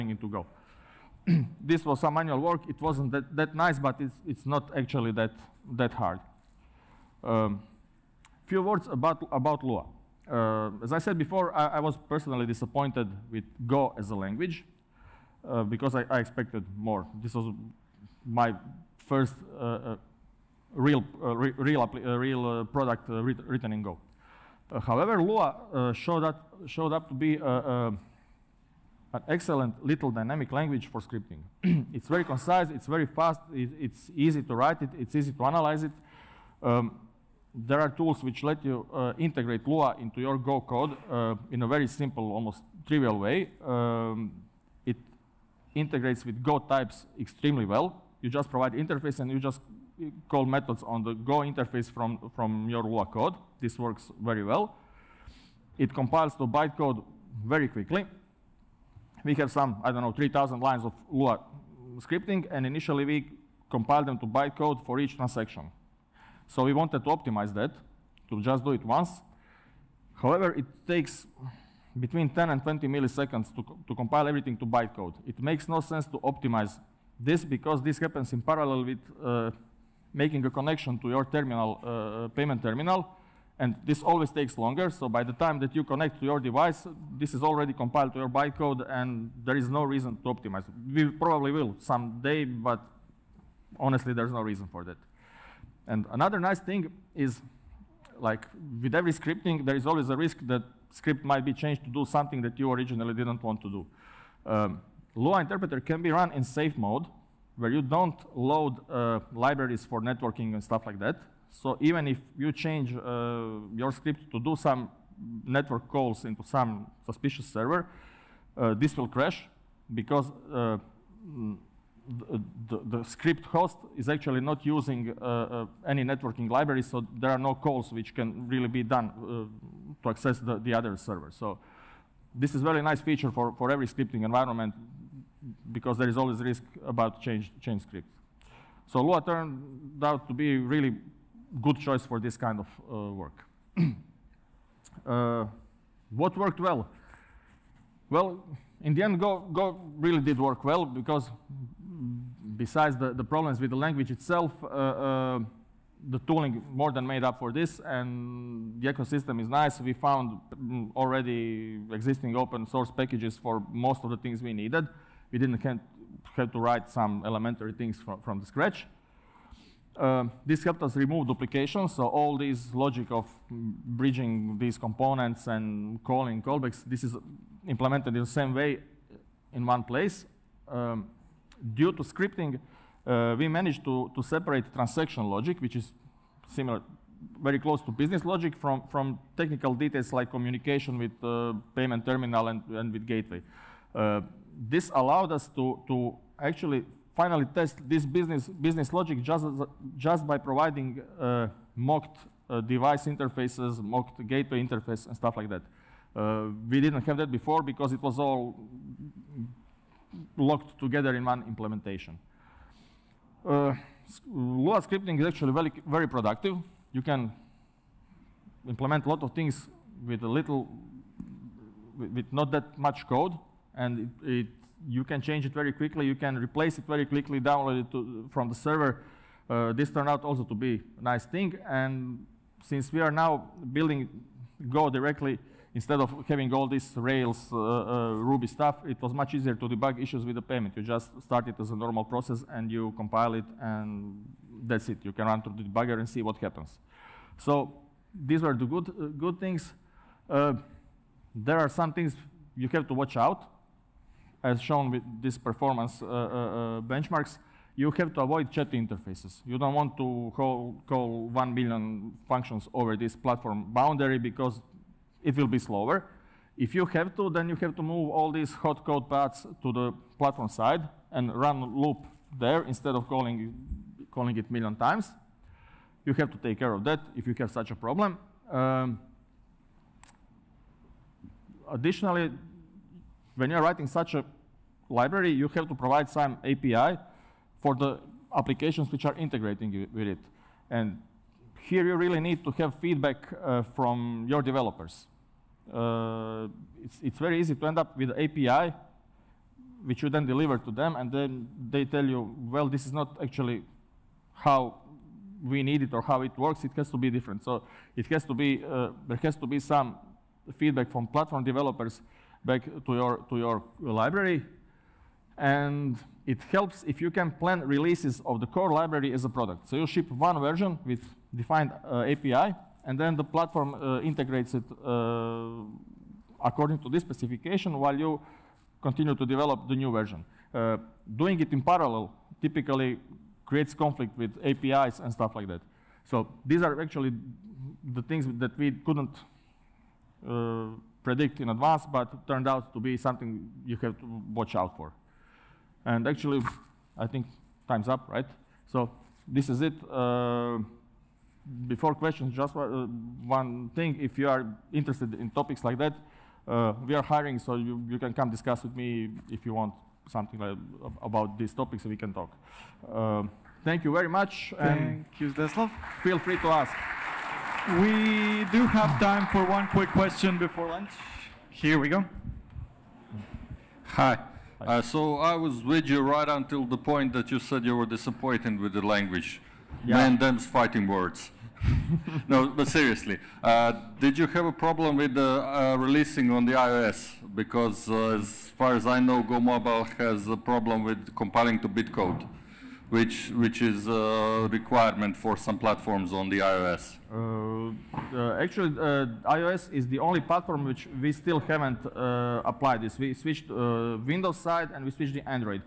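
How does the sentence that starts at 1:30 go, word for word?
We probably will someday, but honestly, there's no reason for that.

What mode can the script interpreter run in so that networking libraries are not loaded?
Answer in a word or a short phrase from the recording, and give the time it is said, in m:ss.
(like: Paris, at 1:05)
safe mode, at 1:46.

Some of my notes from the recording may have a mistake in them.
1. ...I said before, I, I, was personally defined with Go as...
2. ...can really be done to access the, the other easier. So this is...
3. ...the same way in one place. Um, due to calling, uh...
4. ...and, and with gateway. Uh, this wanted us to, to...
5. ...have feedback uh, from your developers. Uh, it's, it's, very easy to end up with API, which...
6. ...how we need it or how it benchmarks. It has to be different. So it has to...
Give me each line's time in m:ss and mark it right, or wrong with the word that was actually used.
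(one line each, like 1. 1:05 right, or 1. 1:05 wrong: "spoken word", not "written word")
1. 0:10 wrong: "disappointed", not "defined"
2. 2:08 wrong: "server", not "easier"
3. 2:58 wrong: "scripting", not "calling"
4. 3:12 wrong: "allowed", not "wanted"
5. 4:52 right
6. 5:04 wrong: "works", not "benchmarks".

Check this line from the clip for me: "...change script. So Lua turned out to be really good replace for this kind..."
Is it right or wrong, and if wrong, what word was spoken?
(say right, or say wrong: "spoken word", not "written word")
wrong: "choice", not "replace".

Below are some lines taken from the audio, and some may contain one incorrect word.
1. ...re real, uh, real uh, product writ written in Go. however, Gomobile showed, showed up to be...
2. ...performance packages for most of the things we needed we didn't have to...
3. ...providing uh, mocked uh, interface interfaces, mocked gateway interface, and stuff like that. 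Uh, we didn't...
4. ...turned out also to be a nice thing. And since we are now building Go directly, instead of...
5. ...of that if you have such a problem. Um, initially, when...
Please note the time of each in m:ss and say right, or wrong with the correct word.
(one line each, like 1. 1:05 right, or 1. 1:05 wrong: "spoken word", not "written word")
1. 0:21 wrong: "Lua", not "Gomobile"
2. 2:42 wrong: "source", not "performance"
3. 3:20 wrong: "device", not "interface"
4. 3:49 right
5. 4:36 wrong: "additionally", not "initially".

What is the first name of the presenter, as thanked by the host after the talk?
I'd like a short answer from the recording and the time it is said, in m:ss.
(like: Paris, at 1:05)
Zdeslav, at 6:05.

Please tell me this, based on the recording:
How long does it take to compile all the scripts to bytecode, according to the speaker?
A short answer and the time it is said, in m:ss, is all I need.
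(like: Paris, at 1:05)
10 to 20 milliseconds, at 1:12.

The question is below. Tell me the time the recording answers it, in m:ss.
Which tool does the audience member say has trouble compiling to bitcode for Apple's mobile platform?
6:29.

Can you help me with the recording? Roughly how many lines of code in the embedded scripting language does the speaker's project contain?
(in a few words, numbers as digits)
3,000.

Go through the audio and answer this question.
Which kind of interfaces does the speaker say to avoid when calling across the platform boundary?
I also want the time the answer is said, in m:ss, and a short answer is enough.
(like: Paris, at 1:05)
chat interfaces, at 4:18.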